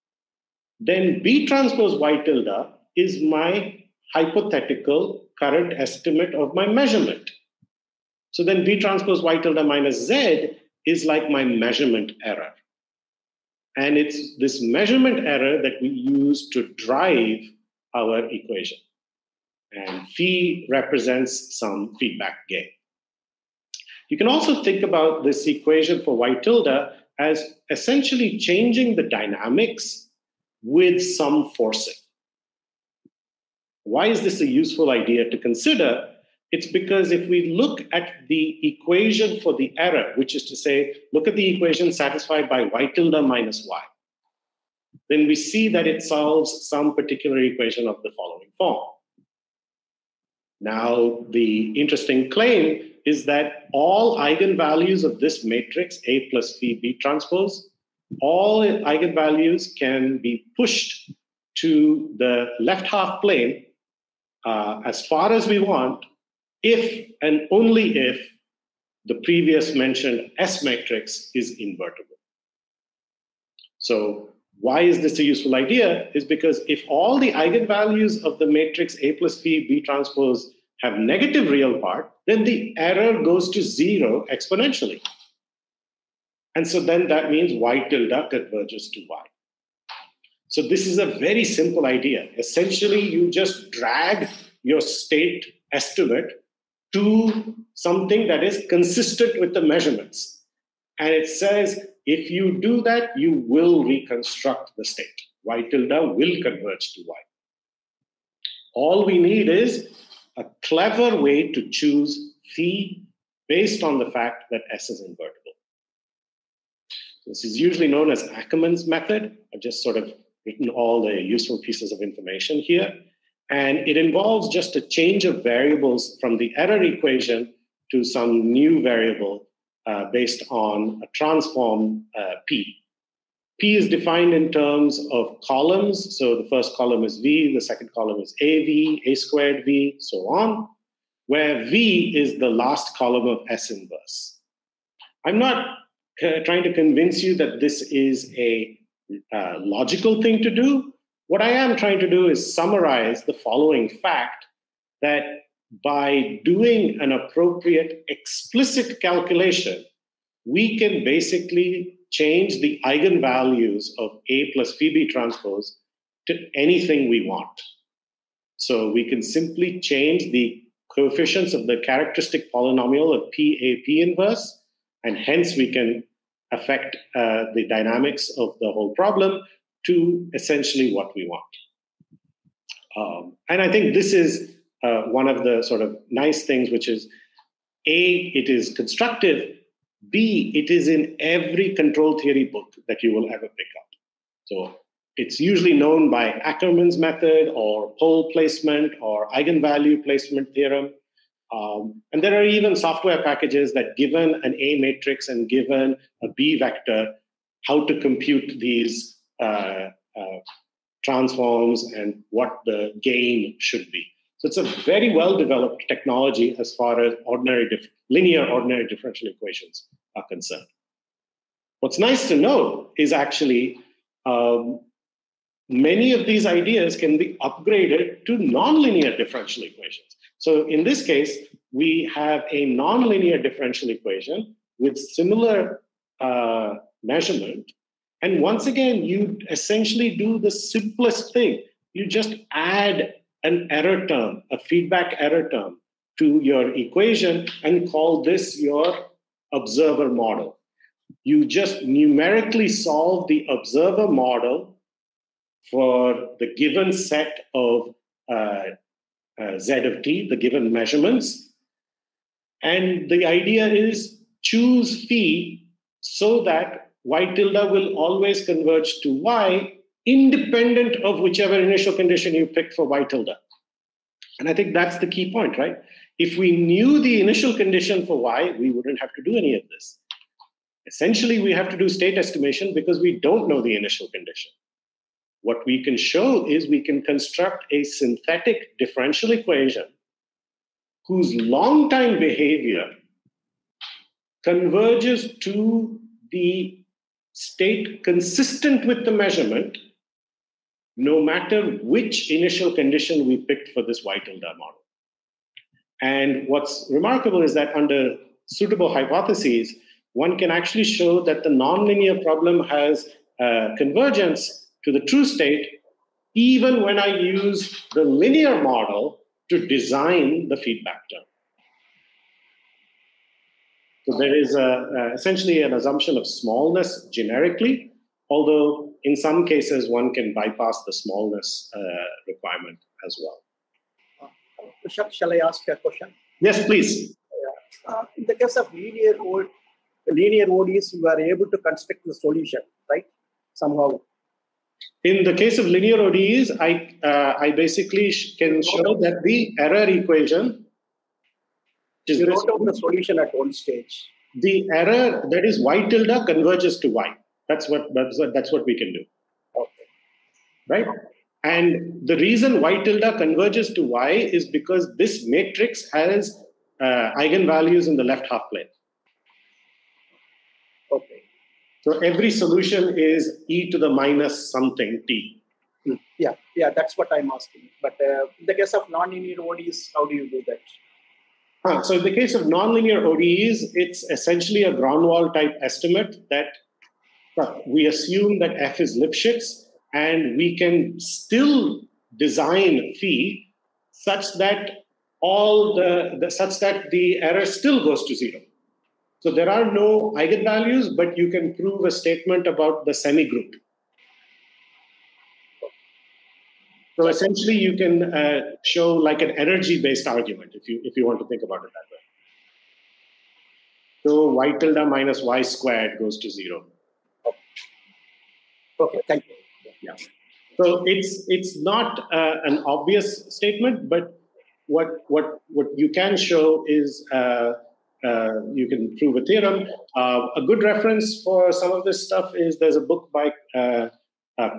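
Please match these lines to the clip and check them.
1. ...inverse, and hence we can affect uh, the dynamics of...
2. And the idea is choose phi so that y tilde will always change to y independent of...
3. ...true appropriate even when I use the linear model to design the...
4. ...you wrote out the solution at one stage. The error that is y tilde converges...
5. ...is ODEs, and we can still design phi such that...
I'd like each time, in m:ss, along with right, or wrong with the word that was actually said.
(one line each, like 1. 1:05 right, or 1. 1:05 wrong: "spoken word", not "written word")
1. 2:53 right
2. 4:22 wrong: "converge", not "change"
3. 5:15 wrong: "state", not "appropriate"
4. 5:52 right
5. 6:28 wrong: "Lipschitz", not "ODEs".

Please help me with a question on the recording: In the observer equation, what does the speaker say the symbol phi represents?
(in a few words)
feedback gain.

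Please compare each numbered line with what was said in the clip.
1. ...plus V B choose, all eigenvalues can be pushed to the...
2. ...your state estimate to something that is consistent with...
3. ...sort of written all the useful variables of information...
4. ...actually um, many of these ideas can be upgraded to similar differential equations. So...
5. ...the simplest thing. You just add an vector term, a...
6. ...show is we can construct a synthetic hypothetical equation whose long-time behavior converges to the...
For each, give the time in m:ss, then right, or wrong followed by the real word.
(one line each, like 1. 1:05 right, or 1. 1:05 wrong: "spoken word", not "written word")
1. 0:56 wrong: "transpose", not "choose"
2. 1:34 right
3. 1:59 wrong: "pieces", not "variables"
4. 3:43 wrong: "nonlinear", not "similar"
5. 4:00 wrong: "error", not "vector"
6. 4:45 wrong: "differential", not "hypothetical".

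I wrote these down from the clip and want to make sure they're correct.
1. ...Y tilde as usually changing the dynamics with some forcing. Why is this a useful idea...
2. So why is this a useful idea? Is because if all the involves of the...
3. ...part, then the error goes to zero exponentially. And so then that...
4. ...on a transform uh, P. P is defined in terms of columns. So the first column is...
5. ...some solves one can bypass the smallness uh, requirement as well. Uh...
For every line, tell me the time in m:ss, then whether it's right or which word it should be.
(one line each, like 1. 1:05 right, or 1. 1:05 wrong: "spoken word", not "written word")
1. 0:26 wrong: "essentially", not "usually"
2. 1:13 wrong: "eigenvalues", not "involves"
3. 1:21 right
4. 2:10 right
5. 5:29 wrong: "cases", not "solves".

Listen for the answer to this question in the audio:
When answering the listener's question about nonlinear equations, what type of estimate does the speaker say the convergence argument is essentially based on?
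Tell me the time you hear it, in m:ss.
6:24.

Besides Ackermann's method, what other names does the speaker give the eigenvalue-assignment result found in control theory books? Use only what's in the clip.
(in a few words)
pole placement or eigenvalue placement theorem.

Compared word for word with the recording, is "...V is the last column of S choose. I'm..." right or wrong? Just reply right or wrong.
wrong.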